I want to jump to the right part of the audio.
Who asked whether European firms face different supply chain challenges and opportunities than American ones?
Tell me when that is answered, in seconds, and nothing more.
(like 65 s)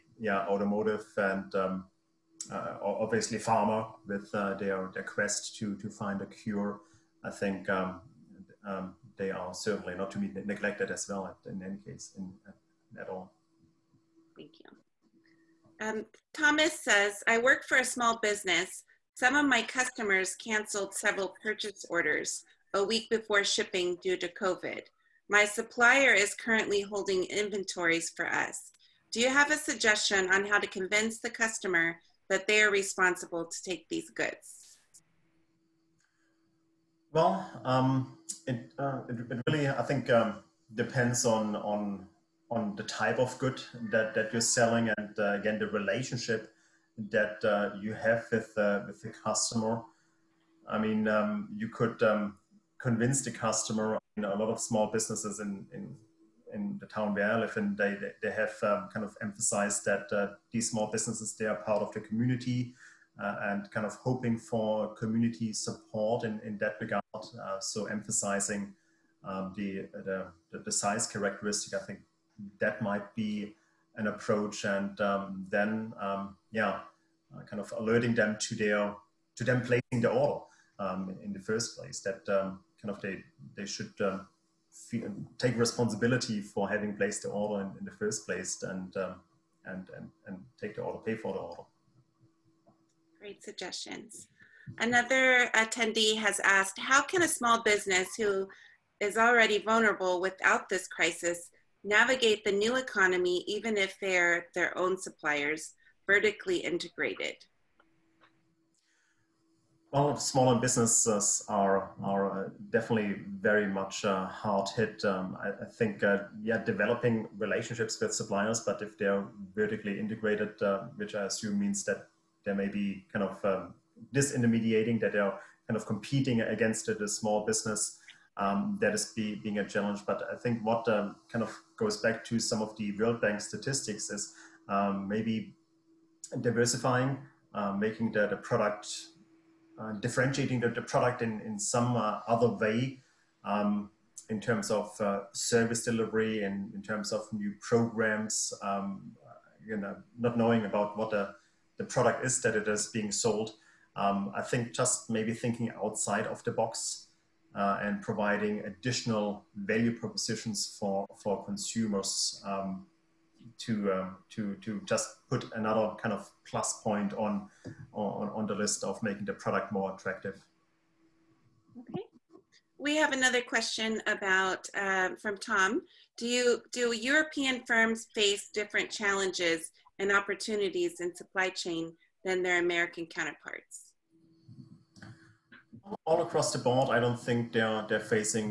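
175 s.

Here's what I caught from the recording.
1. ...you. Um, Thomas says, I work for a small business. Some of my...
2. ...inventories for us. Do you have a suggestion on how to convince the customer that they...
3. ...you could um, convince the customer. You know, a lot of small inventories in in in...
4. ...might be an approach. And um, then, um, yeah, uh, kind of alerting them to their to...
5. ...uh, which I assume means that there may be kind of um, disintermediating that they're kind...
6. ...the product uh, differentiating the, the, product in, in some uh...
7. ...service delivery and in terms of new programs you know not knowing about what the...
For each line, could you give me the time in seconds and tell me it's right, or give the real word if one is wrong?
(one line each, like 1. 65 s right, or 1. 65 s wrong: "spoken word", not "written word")
1. 14 s right
2. 27 s right
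3. 51 s wrong: "businesses", not "inventories"
4. 72 s right
5. 120 s right
6. 138 s right
7. 145 s right.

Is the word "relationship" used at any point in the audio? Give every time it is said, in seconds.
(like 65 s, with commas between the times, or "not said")
45 s, 117 s.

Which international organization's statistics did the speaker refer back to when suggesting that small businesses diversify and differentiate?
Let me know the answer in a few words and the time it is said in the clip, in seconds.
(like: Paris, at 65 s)
World Bank, at 132 s.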